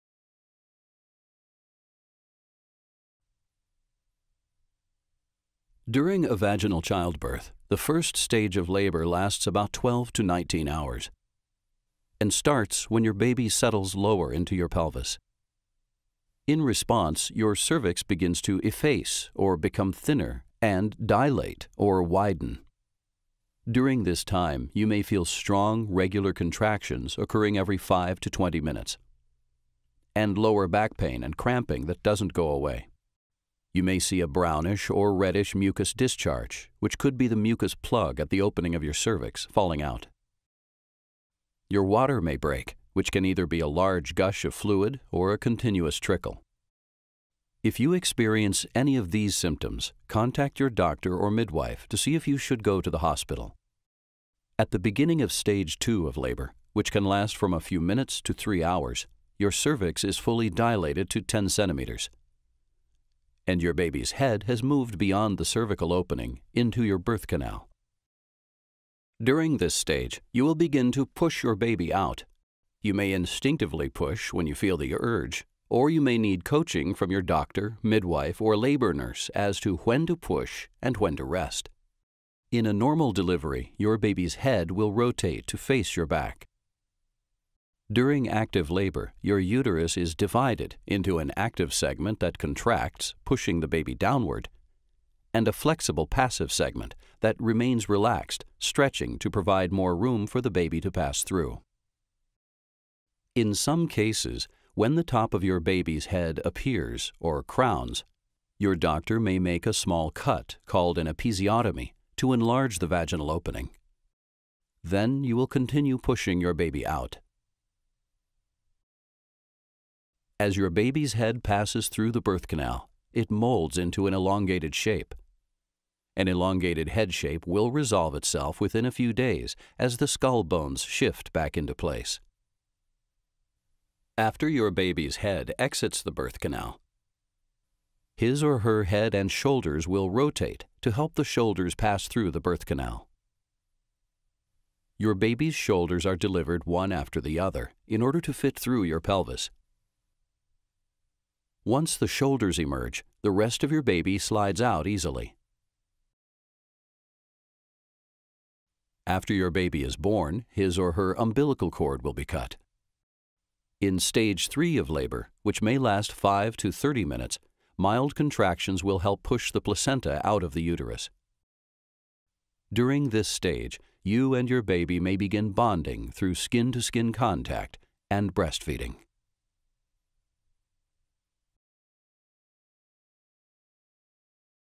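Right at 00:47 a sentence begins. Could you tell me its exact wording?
If you experience any of these symptoms, contact your doctor or midwife to see if you should go to the hospital.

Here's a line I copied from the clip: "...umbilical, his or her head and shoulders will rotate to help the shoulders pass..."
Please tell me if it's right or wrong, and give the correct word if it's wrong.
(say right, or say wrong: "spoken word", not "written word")
wrong: "canal", not "umbilical".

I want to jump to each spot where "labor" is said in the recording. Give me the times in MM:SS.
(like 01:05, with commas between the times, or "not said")
00:08, 00:56, 01:18, 01:28, 02:44.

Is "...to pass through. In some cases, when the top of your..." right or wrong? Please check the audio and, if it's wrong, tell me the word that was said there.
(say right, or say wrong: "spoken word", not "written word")
right.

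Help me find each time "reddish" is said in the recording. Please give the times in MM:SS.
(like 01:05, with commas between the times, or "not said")
00:35.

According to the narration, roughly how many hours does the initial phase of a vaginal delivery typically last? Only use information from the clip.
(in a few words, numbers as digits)
12 to 19 hours.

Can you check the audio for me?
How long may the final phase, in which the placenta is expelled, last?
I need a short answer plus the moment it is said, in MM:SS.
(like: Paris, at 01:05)
5 to 30 minutes, at 02:46.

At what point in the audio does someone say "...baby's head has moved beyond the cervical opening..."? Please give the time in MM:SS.
01:03.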